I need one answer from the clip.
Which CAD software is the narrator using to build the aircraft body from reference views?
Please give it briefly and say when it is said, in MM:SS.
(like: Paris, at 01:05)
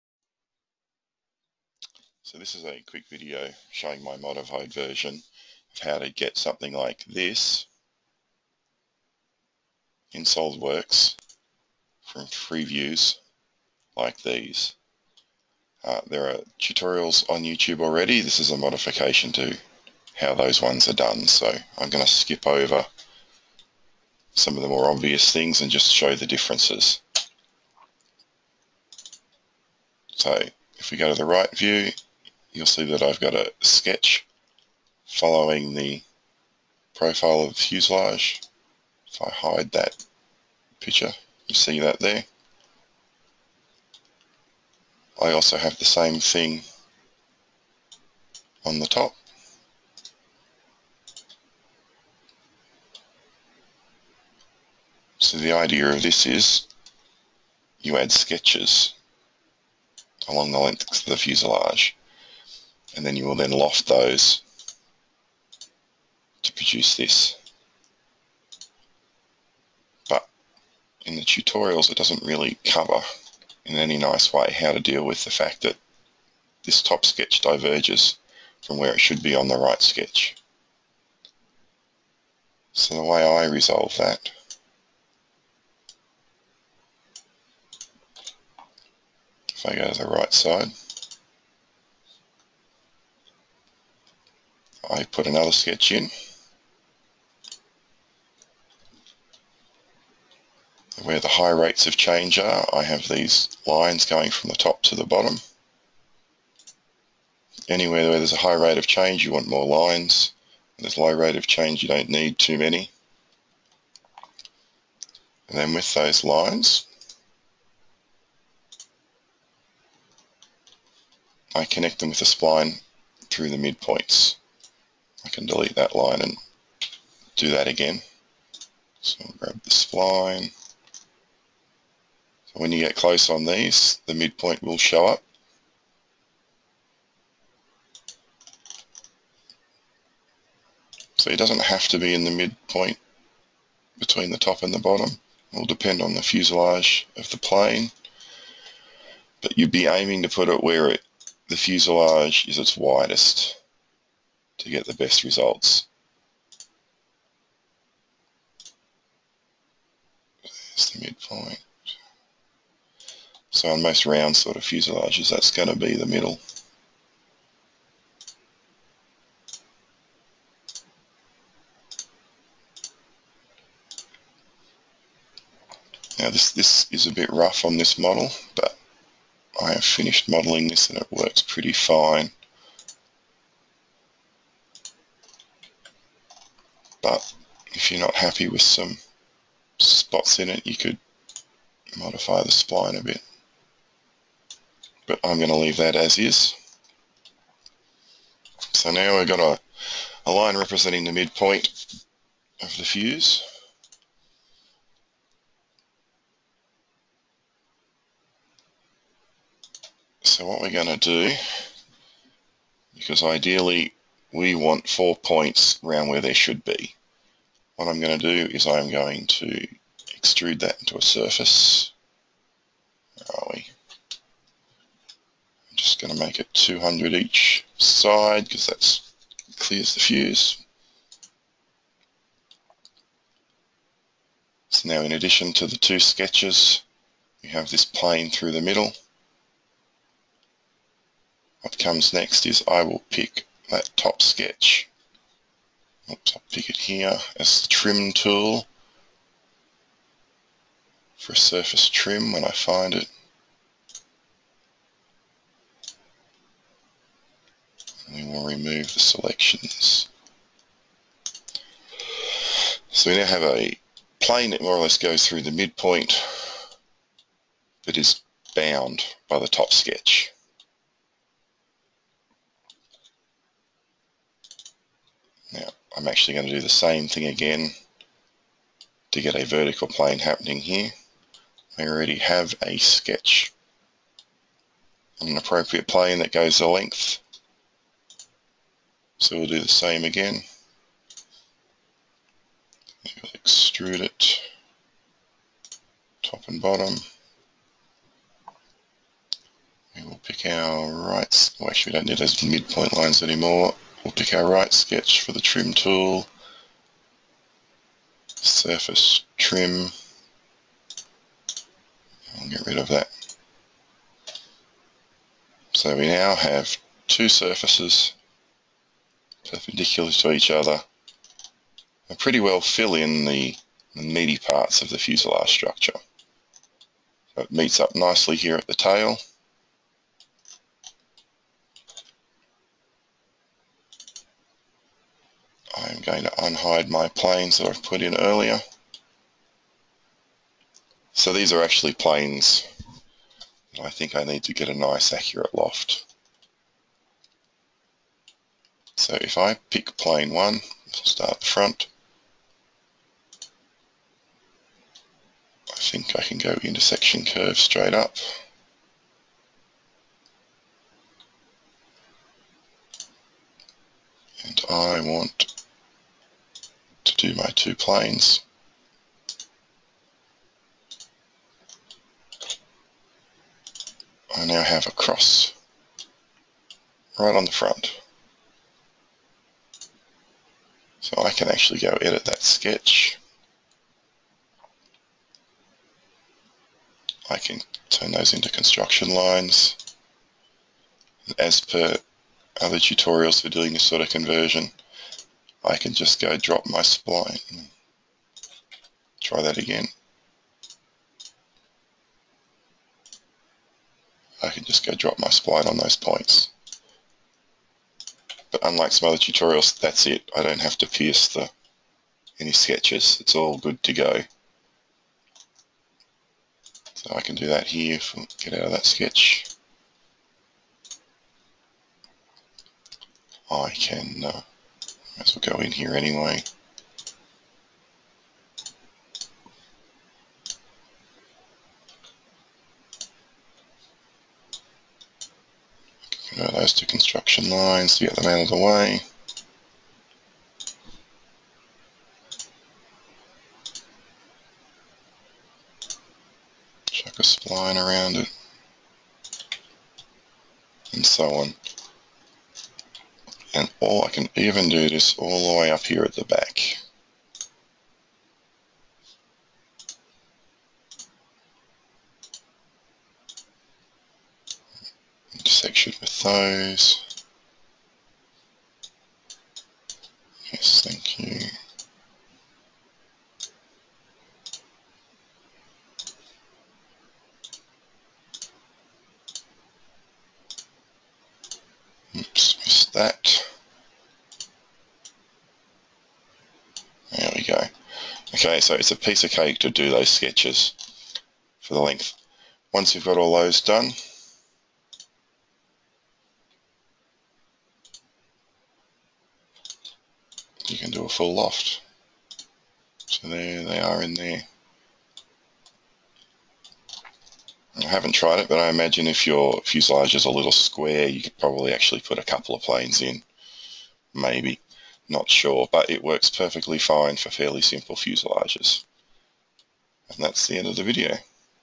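SOLIDWORKS, at 00:10.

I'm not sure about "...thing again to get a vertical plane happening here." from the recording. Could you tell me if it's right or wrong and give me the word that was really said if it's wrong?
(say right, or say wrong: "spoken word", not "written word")
right.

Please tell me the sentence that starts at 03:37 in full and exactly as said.
What I'm going to do is I'm going to extrude that into a surface.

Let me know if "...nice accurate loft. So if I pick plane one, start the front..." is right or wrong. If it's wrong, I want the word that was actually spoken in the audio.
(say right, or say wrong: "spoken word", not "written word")
right.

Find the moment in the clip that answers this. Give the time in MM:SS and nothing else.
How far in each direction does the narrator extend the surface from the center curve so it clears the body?
03:46.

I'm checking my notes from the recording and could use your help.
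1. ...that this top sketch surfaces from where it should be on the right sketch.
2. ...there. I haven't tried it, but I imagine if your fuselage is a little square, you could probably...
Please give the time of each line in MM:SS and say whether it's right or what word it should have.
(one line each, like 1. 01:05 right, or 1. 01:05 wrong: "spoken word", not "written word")
1. 01:15 wrong: "diverges", not "surfaces"
2. 08:24 right.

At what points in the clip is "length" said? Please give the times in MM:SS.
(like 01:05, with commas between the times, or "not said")
01:00, 04:46, 08:11.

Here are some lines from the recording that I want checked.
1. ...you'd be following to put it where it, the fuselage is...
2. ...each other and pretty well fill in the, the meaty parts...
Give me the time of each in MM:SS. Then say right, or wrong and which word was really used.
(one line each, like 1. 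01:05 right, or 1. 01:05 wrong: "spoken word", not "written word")
1. 02:29 wrong: "aiming", not "following"
2. 05:20 right.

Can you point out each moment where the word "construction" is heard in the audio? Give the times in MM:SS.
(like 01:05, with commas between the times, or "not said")
06:28, 07:16.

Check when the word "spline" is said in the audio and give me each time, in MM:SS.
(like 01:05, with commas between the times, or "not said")
02:02, 03:12, 06:36, 06:45, 07:27.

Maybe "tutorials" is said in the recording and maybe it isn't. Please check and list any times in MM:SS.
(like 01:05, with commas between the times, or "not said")
00:16, 01:11, 06:32, 06:49.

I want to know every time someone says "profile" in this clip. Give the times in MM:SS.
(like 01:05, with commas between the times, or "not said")
00:36.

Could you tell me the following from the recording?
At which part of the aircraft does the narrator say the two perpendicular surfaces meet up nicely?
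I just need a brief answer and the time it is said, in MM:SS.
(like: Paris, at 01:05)
the tail, at 05:28.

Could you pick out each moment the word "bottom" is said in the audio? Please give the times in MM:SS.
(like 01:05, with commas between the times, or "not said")
01:45, 02:24, 04:56.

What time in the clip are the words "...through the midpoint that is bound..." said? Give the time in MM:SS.
04:25.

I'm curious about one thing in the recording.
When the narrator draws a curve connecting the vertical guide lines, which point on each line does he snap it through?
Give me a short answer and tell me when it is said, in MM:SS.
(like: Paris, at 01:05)
midpoints, at 02:03.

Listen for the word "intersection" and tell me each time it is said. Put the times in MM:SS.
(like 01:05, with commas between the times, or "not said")
05:56, 07:45.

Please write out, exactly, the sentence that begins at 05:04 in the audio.
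We'll pick our right sketch for the trim tool, surface trim, I'll get rid of that.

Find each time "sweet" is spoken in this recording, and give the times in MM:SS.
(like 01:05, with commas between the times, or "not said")
not said.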